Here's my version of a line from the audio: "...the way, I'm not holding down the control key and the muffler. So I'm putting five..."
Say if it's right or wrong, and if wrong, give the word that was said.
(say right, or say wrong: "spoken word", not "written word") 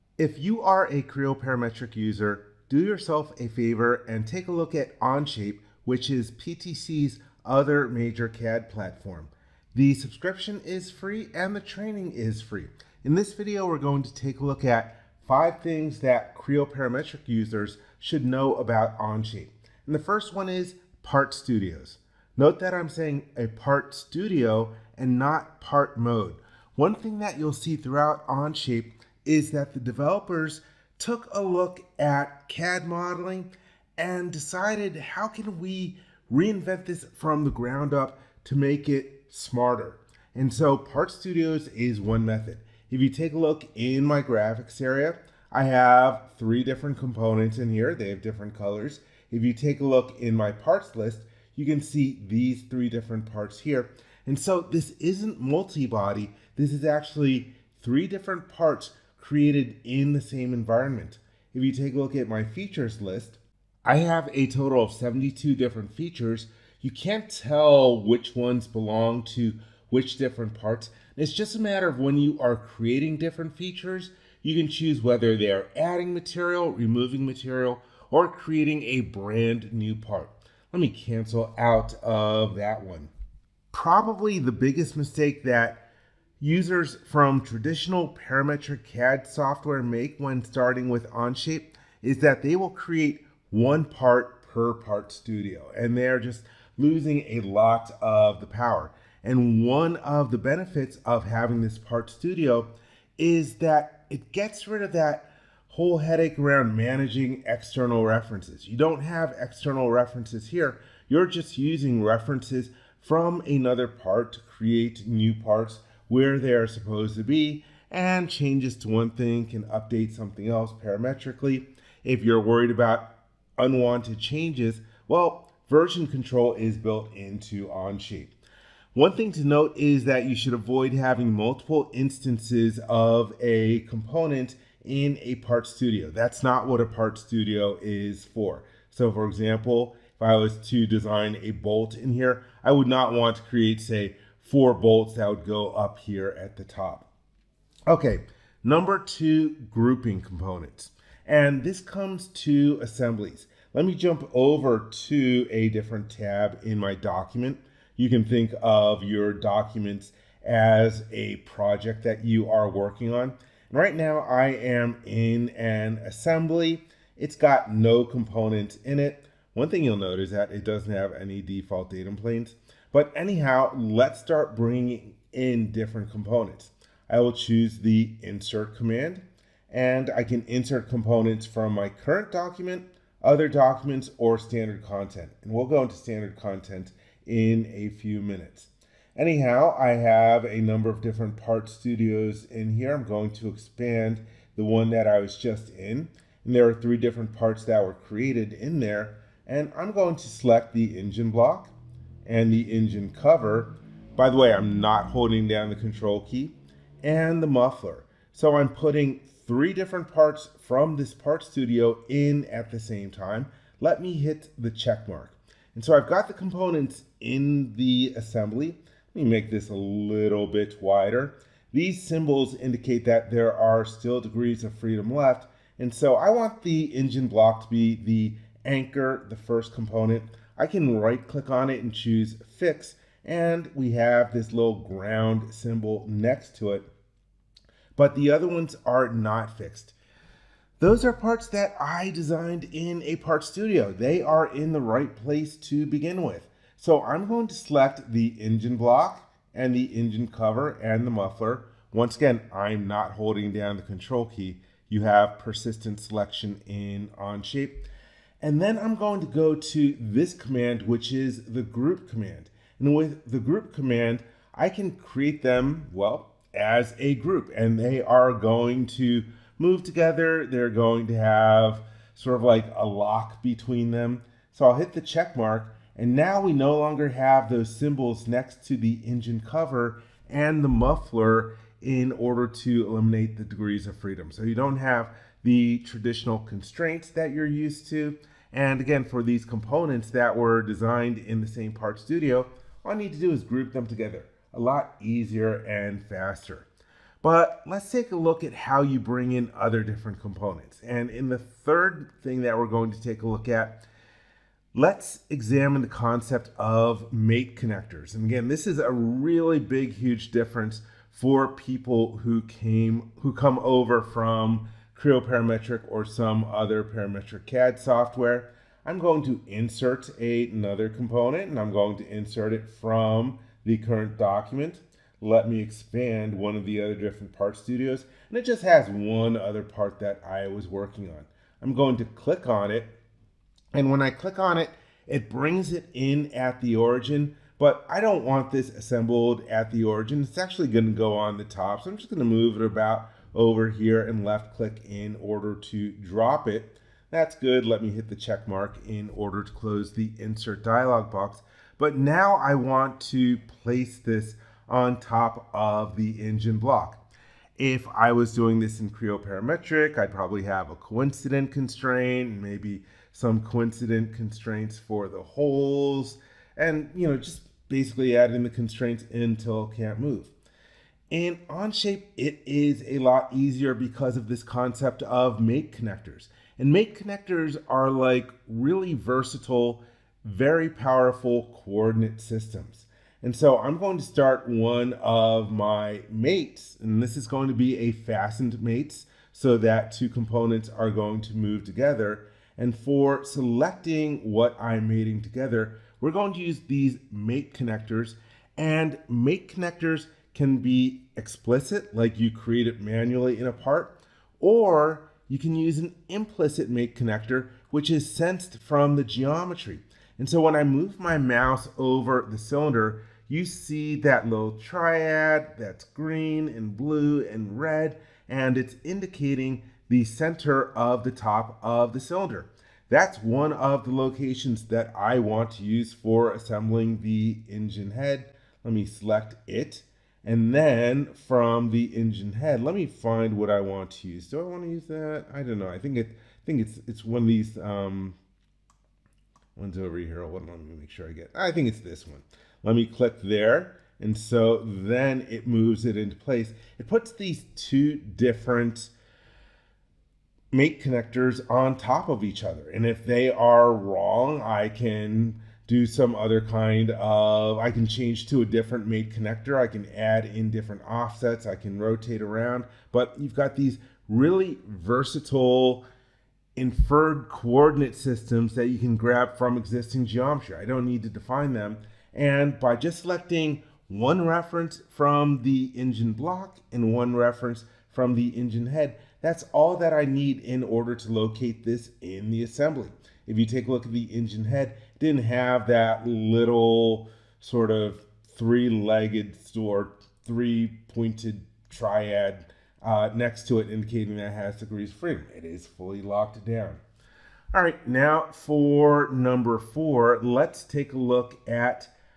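wrong: "three", not "five".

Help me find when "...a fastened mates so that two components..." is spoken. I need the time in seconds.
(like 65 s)
387 s.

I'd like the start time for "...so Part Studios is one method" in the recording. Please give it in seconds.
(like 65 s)
40 s.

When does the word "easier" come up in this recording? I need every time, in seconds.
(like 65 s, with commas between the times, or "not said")
295 s, 373 s.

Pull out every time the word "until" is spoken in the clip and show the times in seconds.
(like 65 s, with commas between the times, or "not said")
369 s.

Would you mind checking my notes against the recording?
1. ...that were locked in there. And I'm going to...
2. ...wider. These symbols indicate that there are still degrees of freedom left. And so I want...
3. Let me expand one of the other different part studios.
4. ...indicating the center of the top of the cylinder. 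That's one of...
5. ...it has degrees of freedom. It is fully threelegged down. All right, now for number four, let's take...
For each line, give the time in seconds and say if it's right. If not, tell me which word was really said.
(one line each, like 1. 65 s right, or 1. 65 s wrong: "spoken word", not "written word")
1. 197 s wrong: "created", not "locked"
2. 220 s right
3. 325 s right
4. 418 s right
5. 494 s wrong: "locked", not "threelegged".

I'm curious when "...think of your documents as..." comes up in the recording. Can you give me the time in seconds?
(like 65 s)
158 s.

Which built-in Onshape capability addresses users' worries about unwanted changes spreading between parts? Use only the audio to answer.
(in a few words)
Version control.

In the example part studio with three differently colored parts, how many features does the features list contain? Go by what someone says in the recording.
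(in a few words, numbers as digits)
72.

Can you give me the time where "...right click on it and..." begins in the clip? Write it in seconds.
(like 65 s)
231 s.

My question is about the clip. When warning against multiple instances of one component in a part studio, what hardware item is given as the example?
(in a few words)
A bolt.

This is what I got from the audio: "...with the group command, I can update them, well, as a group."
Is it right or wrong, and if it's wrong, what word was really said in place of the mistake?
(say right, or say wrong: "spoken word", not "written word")
wrong: "create", not "update".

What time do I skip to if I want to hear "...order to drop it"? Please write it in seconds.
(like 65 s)
345 s.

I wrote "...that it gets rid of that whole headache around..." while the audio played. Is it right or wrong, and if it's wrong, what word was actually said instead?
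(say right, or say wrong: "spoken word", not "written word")
right.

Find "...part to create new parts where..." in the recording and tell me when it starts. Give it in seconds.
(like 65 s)
113 s.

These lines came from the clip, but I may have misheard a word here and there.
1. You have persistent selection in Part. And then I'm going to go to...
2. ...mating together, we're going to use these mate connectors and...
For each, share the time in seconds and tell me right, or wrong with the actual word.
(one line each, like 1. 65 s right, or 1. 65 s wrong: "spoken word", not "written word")
1. 254 s wrong: "Onshape", not "Part"
2. 394 s right.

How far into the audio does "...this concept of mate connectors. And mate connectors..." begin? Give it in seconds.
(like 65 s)
374 s.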